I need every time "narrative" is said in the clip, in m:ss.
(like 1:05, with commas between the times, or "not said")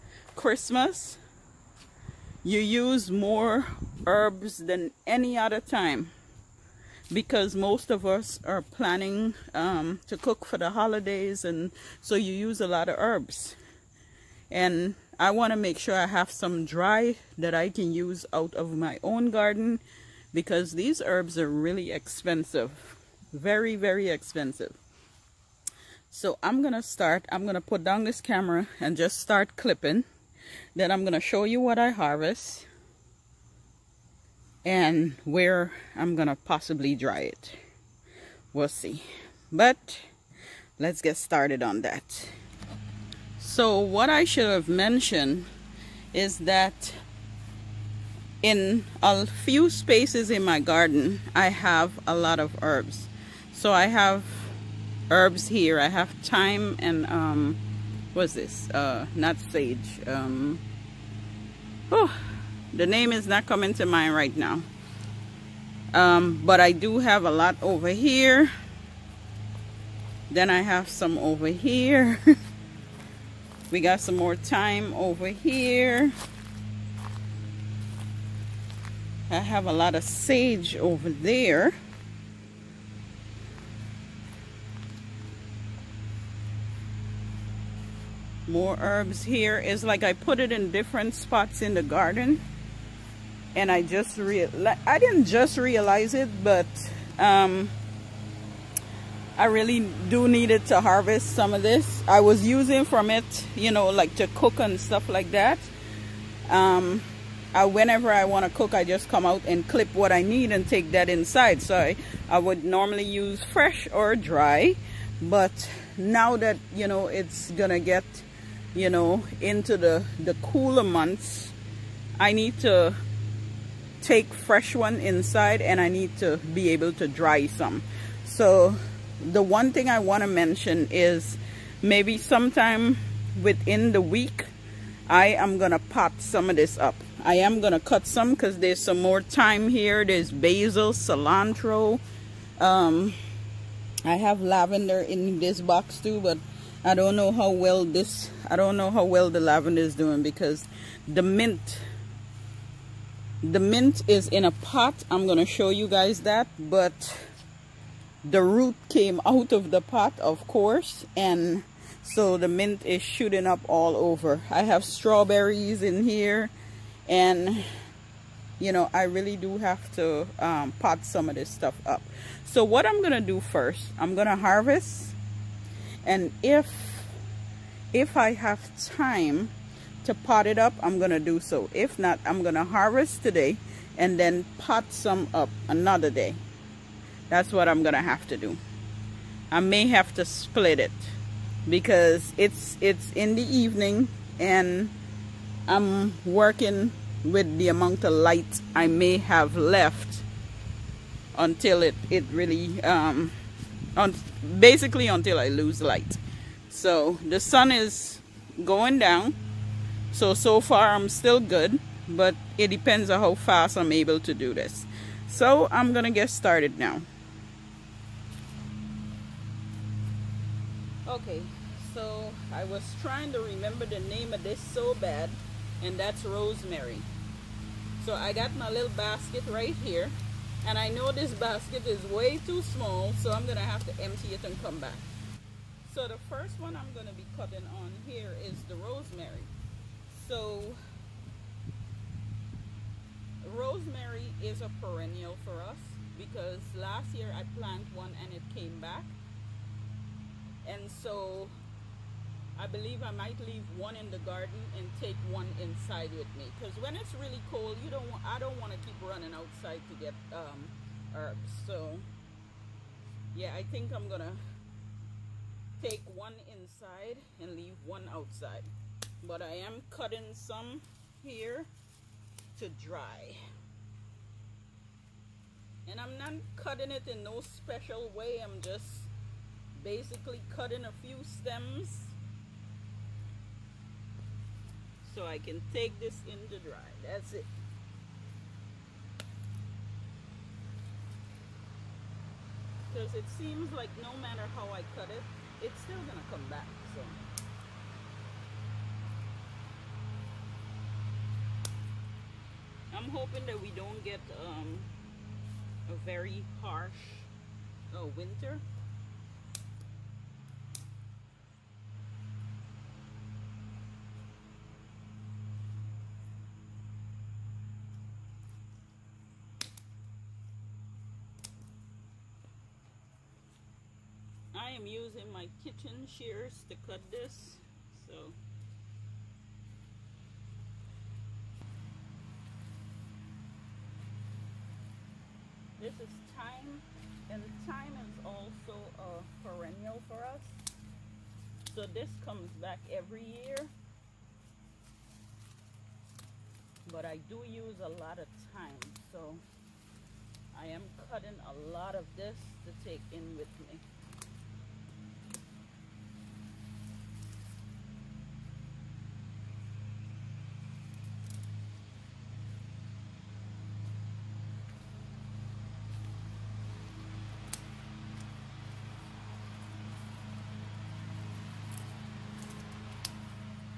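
not said.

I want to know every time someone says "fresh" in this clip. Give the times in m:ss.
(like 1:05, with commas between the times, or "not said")
1:53, 2:04.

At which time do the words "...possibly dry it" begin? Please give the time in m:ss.
0:36.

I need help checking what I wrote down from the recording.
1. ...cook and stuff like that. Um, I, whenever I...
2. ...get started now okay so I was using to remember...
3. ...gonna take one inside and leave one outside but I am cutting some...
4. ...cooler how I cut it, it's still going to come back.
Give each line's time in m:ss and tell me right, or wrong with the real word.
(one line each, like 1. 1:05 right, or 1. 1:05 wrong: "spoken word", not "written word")
1. 1:44 right
2. 3:36 wrong: "trying", not "using"
3. 4:24 right
4. 4:54 wrong: "matter", not "cooler".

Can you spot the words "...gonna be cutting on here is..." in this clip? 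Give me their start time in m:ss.
3:56.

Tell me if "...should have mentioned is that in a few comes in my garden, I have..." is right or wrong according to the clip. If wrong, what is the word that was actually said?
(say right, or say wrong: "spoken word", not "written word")
wrong: "spaces", not "comes".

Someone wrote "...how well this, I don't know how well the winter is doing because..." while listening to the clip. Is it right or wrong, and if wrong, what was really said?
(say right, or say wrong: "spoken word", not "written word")
wrong: "lavender", not "winter".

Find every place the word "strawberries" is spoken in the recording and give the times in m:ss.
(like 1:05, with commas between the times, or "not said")
2:44.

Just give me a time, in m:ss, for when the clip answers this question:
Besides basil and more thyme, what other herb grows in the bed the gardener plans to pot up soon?
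2:20.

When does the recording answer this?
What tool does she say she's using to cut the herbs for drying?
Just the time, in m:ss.
5:25.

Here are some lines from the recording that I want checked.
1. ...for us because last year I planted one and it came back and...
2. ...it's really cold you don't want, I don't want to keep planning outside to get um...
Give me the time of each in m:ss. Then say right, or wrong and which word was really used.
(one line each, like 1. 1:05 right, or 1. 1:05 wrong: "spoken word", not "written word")
1. 4:05 right
2. 4:16 wrong: "running", not "planning".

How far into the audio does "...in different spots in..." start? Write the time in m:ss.
1:30.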